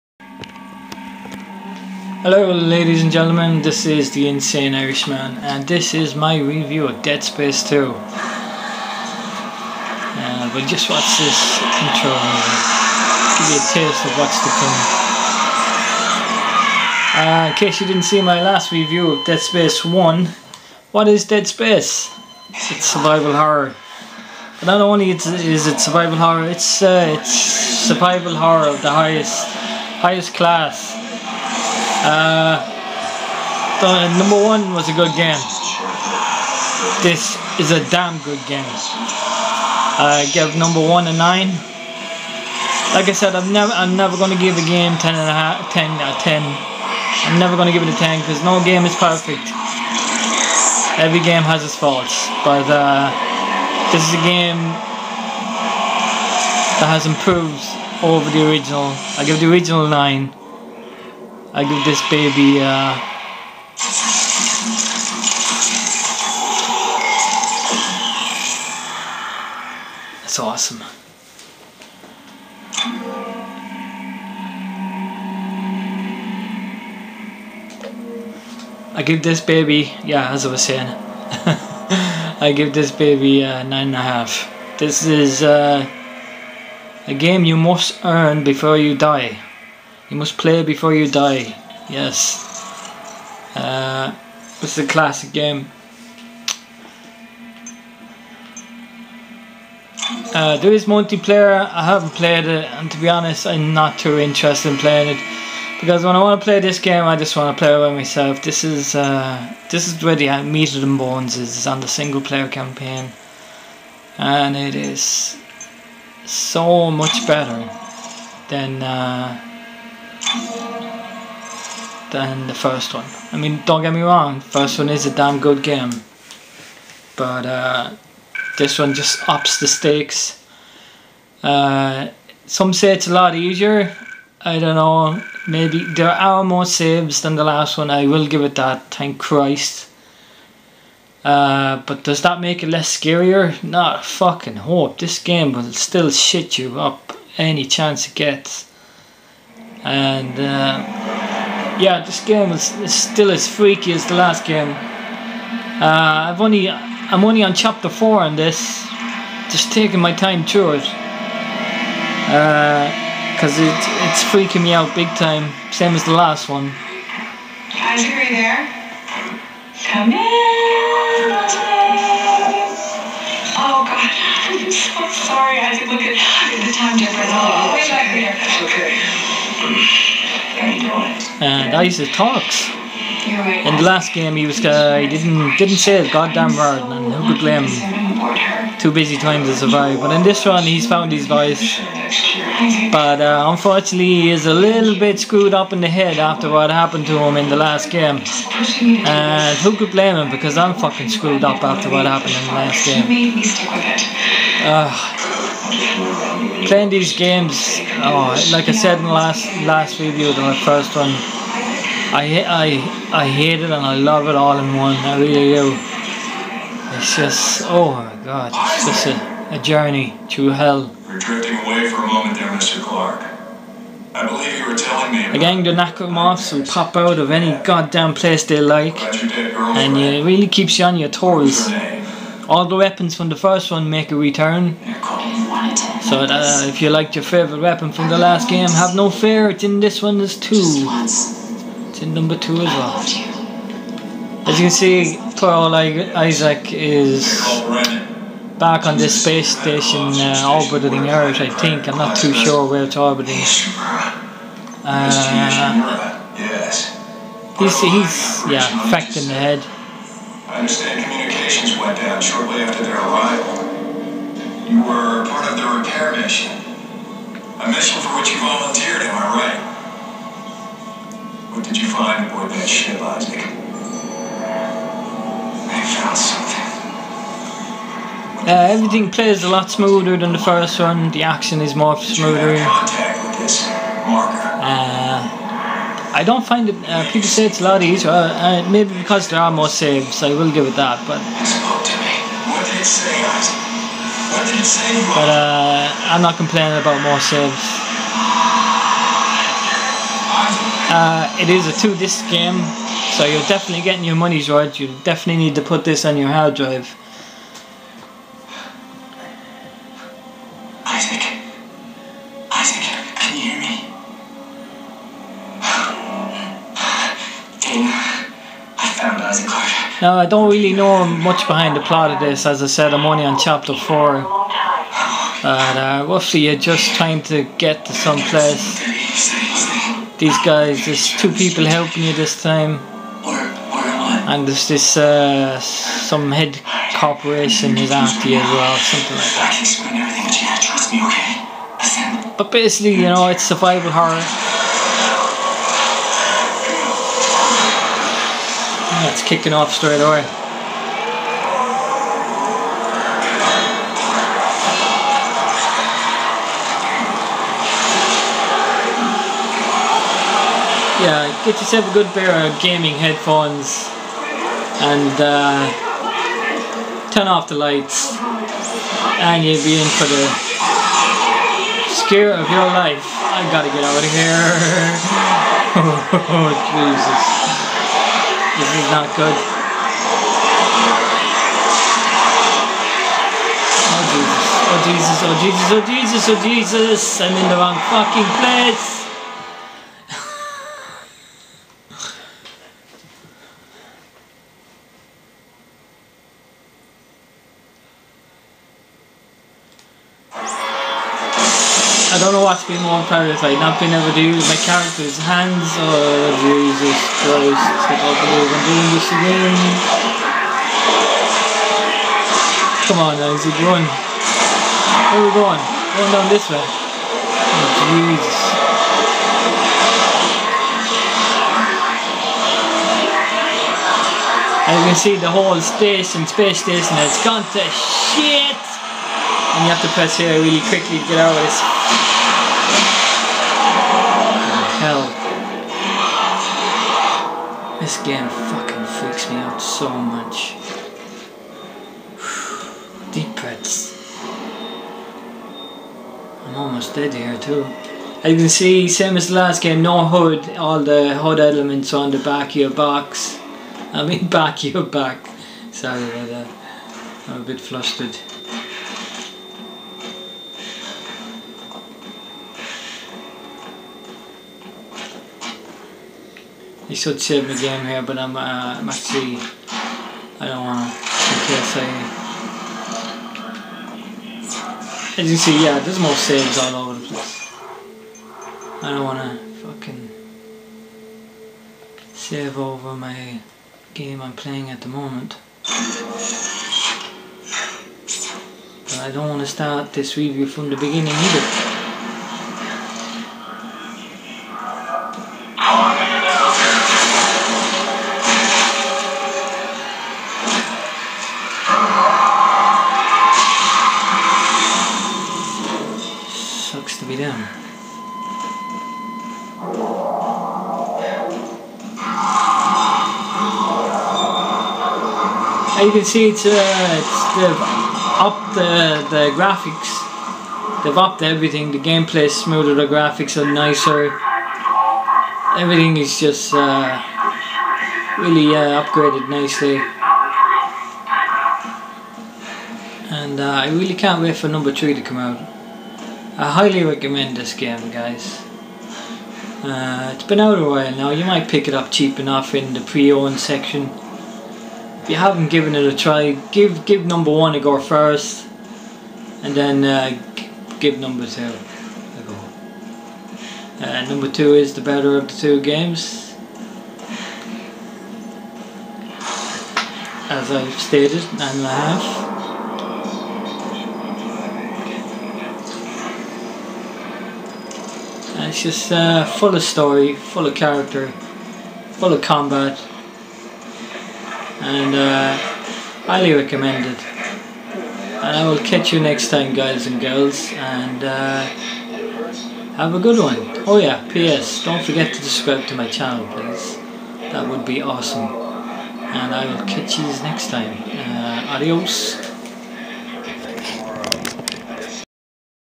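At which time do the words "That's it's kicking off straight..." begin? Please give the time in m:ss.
5:49.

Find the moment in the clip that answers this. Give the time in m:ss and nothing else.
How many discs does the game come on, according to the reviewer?
5:01.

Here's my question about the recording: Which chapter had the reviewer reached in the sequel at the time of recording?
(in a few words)
Chapter 4.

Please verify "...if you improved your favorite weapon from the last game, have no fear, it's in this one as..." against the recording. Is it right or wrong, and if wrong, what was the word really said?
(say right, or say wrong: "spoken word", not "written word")
wrong: "liked", not "improved".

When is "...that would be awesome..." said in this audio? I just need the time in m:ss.
9:47.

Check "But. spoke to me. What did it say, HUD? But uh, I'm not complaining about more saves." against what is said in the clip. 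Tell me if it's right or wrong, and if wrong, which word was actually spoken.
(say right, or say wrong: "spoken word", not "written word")
wrong: "Isaac", not "HUD".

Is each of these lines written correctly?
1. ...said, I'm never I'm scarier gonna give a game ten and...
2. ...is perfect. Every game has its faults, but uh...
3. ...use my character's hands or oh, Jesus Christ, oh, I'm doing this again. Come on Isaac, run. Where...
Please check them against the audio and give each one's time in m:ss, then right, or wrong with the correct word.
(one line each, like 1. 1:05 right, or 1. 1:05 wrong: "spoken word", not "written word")
1. 0:43 wrong: "never", not "scarier"
2. 0:48 right
3. 6:44 right.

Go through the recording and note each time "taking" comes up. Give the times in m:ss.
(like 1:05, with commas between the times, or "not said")
2:39.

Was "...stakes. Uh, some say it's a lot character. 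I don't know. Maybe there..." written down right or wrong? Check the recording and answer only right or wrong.
wrong.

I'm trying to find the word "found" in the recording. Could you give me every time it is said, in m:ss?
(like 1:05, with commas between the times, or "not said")
3:10, 4:35.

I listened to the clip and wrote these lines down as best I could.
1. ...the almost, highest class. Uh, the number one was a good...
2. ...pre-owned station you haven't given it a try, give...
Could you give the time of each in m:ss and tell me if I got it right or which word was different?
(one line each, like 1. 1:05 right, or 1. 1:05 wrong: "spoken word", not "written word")
1. 0:28 wrong: "highest", not "almost"
2. 9:02 wrong: "section", not "station".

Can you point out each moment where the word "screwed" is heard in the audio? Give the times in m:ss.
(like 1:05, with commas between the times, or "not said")
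3:15, 3:21.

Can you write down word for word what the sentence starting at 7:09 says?
and you have to press here really quickly to get out of this hell.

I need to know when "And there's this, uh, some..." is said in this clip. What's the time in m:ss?
5:34.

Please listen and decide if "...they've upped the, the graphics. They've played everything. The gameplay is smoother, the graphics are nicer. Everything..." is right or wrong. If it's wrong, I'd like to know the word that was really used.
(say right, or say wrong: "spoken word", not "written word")
wrong: "upped", not "played".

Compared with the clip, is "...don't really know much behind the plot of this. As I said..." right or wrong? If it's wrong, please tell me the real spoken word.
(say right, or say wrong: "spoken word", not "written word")
right.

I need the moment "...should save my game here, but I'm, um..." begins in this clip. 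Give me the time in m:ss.
7:46.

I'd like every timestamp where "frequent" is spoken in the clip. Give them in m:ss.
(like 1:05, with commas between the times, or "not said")
not said.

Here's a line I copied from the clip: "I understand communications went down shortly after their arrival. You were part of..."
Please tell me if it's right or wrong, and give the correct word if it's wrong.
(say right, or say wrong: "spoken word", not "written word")
right.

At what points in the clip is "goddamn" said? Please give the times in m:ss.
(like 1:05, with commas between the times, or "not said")
3:06, 3:47.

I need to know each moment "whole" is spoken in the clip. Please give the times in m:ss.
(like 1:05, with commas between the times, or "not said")
7:05.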